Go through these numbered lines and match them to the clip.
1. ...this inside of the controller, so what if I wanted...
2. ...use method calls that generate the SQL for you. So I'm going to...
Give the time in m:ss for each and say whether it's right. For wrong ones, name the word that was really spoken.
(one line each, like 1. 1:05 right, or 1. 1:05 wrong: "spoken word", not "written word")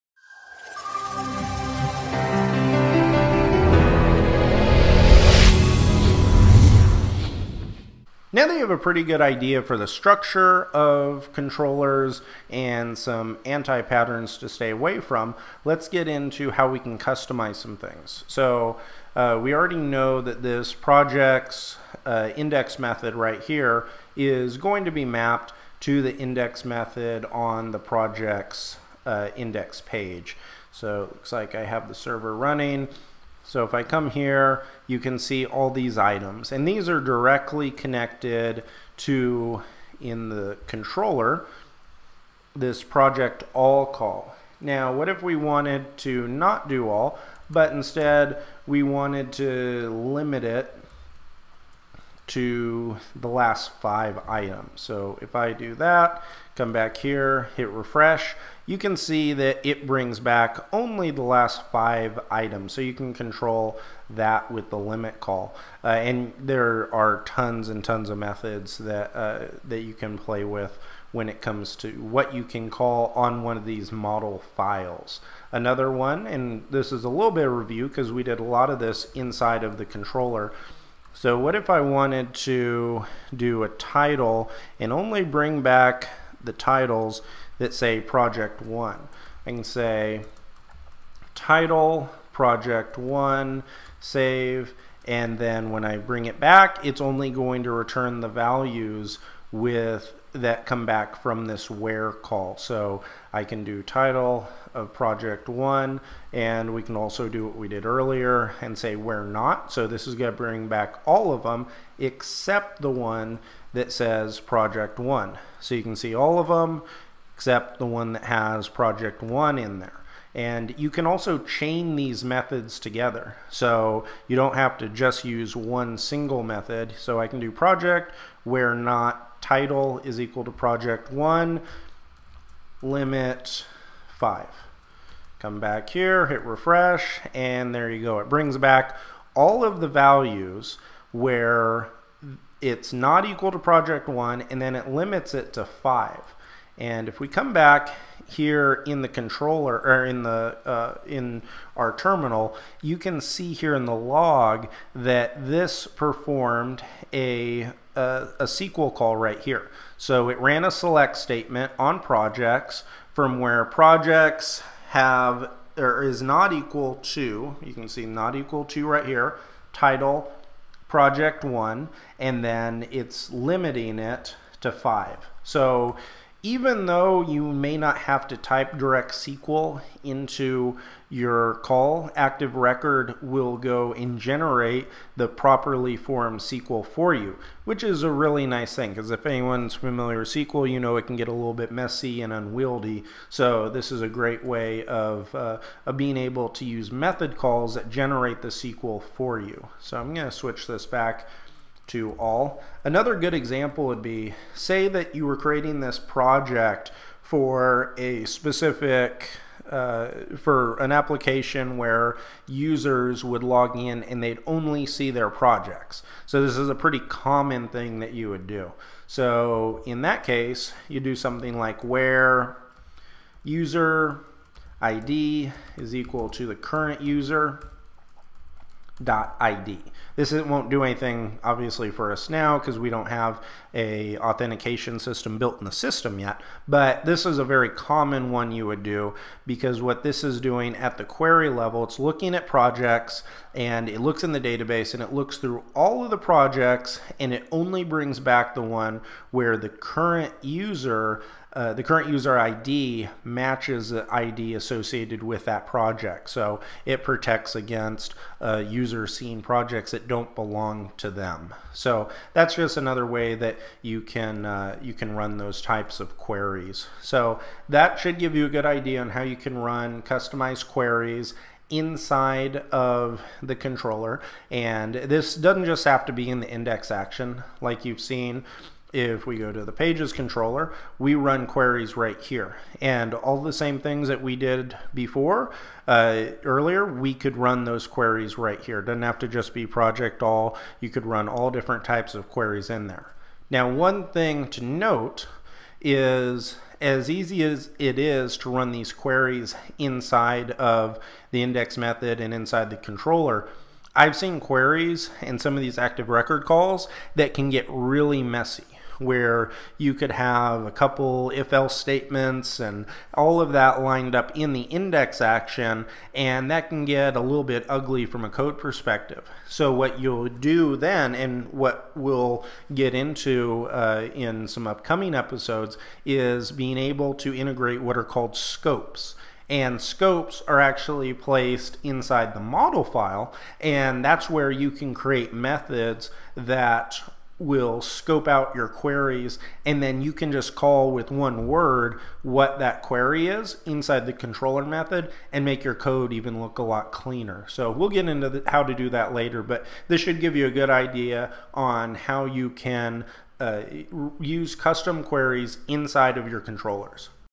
1. 1:18 right
2. 3:16 right.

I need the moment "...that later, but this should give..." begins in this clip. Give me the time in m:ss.
5:48.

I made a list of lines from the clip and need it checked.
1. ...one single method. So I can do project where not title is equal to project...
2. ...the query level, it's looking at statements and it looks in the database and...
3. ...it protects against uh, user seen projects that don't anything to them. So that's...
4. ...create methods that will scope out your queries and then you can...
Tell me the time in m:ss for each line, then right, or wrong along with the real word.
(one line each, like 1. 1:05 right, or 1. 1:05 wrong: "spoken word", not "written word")
1. 2:05 right
2. 4:00 wrong: "projects", not "statements"
3. 4:16 wrong: "belong", not "anything"
4. 5:34 right.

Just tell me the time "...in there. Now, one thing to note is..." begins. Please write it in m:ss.
4:52.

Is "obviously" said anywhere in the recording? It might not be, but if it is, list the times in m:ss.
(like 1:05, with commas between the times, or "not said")
3:51.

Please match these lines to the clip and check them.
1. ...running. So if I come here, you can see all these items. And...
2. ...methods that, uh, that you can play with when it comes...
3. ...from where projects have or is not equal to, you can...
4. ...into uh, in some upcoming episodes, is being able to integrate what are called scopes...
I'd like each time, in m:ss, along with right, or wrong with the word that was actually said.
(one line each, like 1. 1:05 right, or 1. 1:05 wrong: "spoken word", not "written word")
1. 0:32 right
2. 1:08 right
3. 2:43 right
4. 5:22 right.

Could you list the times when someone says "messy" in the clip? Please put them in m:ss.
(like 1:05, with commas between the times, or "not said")
3:11, 5:08.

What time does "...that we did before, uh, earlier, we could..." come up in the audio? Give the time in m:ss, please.
4:44.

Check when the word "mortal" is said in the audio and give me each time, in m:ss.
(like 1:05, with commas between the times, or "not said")
not said.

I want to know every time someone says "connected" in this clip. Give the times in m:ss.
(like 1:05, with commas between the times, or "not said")
0:37.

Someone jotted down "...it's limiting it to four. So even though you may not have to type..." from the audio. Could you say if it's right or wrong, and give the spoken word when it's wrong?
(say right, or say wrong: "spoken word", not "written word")
wrong: "five", not "four".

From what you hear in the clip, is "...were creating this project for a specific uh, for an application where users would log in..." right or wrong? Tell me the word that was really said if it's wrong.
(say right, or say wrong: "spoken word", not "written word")
right.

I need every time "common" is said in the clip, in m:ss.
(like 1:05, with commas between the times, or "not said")
3:36, 3:57.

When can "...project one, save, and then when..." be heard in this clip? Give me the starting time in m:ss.
1:32.